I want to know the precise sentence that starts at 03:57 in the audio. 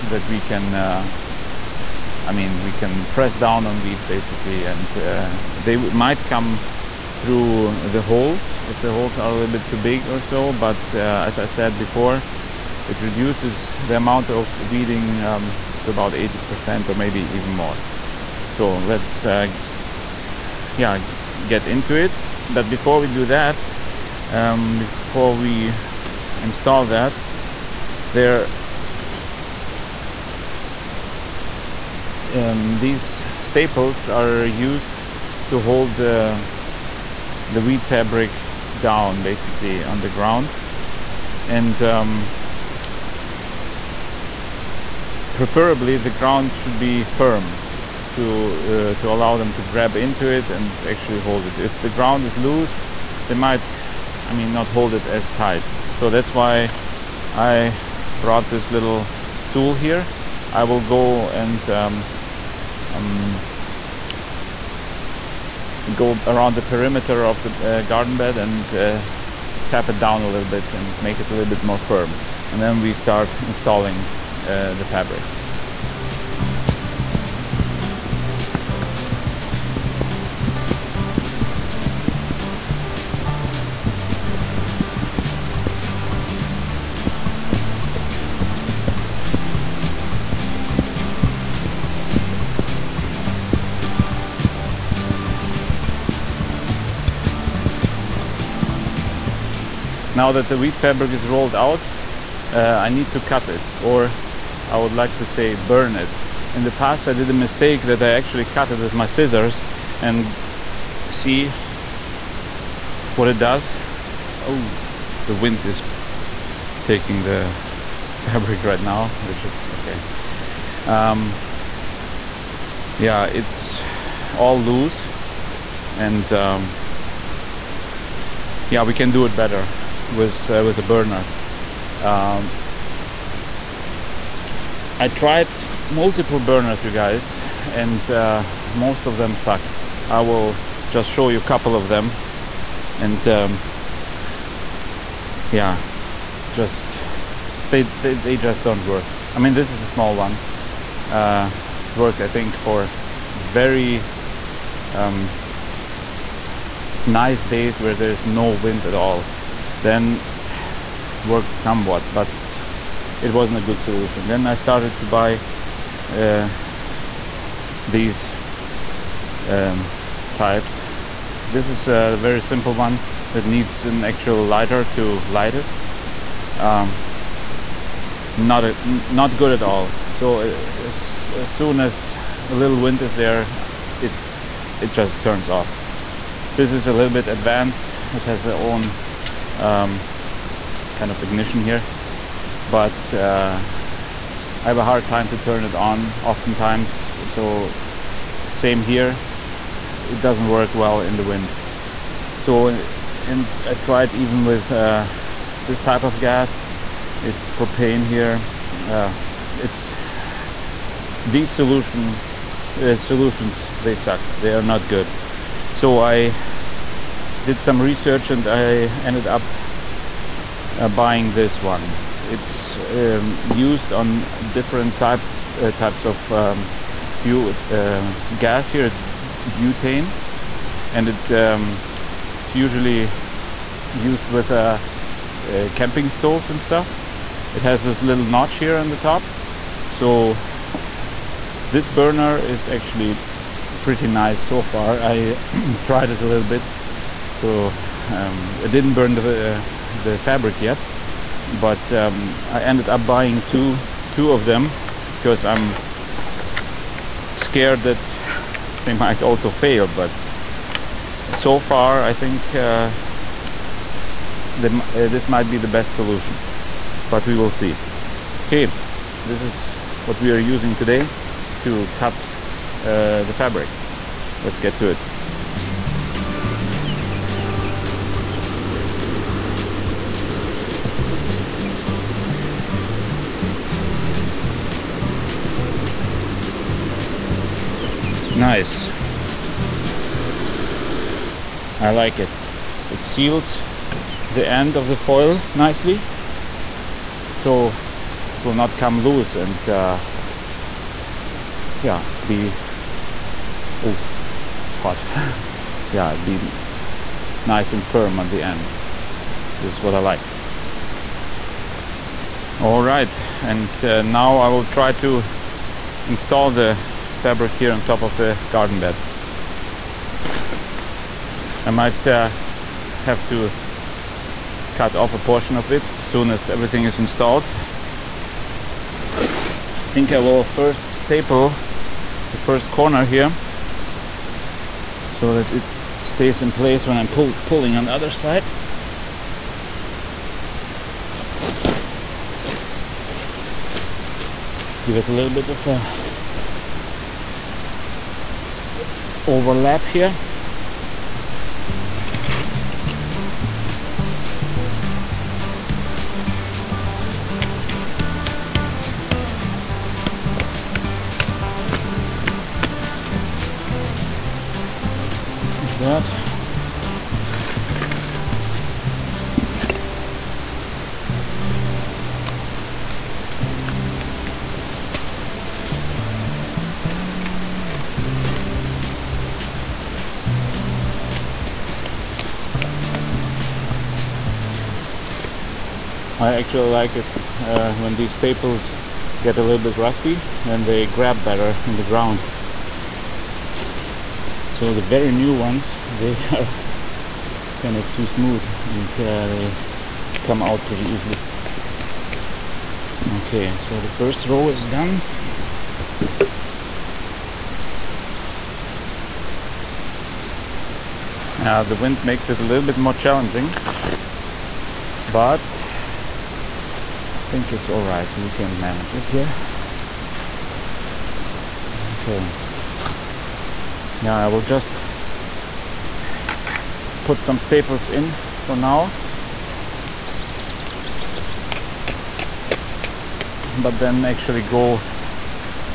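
It has this little notch here on the top, so this burner is actually pretty nice so far.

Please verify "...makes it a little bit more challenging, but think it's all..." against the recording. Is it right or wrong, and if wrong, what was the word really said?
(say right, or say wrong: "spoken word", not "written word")
right.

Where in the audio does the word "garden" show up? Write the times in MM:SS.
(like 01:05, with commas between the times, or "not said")
01:07, 05:18.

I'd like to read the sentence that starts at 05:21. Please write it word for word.
I might uh, have to cut off a portion of it as soon as everything is installed.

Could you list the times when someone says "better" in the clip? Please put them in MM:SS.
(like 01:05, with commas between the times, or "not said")
02:09, 06:31.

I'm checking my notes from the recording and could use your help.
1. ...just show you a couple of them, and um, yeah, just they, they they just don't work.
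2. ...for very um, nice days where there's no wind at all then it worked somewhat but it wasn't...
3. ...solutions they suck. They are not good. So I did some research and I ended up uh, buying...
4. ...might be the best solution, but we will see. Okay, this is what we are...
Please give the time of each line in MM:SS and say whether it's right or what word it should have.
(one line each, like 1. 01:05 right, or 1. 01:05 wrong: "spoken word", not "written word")
1. 02:20 right
2. 02:32 right
3. 03:32 right
4. 04:25 right.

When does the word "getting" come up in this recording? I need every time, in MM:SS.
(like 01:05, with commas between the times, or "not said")
not said.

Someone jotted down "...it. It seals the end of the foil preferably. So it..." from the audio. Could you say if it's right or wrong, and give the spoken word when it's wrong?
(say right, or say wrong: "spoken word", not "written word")
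wrong: "nicely", not "preferably".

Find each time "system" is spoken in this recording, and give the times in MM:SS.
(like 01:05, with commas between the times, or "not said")
not said.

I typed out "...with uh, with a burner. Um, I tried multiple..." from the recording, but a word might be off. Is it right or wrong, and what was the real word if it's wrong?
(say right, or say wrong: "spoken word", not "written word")
right.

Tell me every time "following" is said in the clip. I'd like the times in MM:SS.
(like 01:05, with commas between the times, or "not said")
not said.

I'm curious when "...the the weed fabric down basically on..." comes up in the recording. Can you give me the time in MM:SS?
00:35.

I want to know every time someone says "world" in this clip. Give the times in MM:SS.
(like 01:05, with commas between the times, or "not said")
not said.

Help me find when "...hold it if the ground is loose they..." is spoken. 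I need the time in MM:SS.
00:51.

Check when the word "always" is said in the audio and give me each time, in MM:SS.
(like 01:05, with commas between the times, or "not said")
not said.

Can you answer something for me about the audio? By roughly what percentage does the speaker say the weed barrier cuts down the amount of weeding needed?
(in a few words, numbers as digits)
80%.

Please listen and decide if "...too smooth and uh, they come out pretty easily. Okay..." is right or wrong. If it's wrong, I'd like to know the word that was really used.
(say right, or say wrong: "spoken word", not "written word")
right.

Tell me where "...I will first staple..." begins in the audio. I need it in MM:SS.
05:30.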